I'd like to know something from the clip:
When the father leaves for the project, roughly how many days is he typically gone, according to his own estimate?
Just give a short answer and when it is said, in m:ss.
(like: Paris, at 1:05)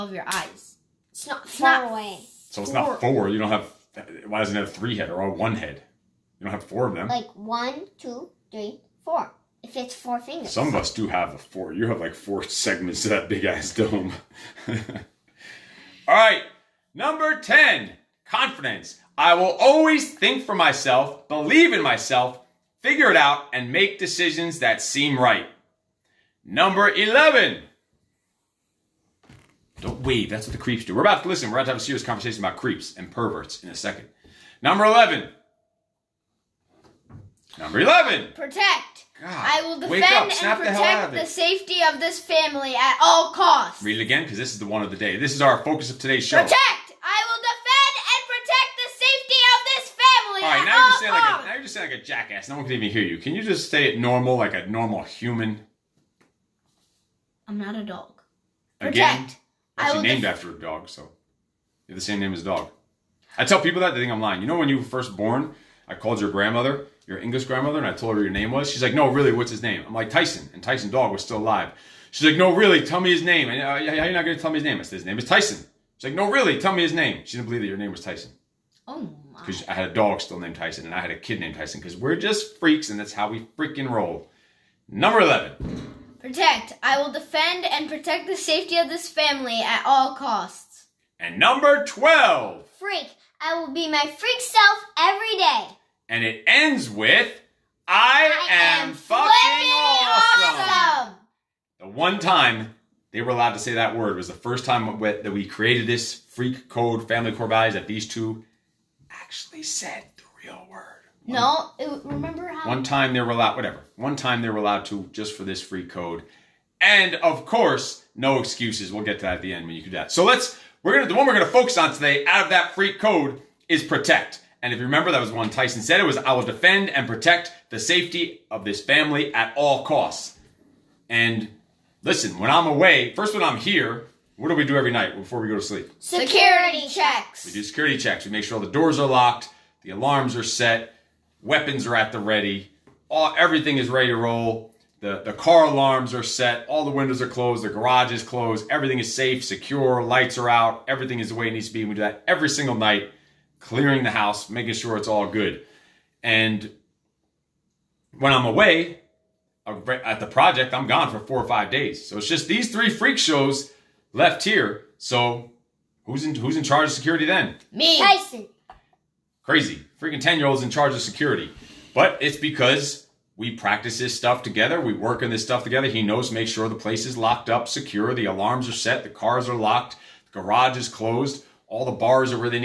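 4 or 5 days, at 2:41.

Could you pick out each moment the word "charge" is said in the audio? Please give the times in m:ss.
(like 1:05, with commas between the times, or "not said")
2:46, 2:50.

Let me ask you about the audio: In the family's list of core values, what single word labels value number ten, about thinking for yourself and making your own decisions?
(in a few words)
Confidence.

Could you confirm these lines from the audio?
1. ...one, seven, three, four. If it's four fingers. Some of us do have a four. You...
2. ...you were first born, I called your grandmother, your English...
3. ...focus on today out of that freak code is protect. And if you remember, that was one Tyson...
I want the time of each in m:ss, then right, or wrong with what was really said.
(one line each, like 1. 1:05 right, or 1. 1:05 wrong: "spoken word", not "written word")
1. 0:07 wrong: "two", not "seven"
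2. 1:04 right
3. 2:01 right.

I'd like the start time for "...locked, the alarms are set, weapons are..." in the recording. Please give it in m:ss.
2:19.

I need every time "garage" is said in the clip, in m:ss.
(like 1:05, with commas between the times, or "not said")
2:27, 3:00.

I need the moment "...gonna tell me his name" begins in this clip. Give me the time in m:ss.
1:14.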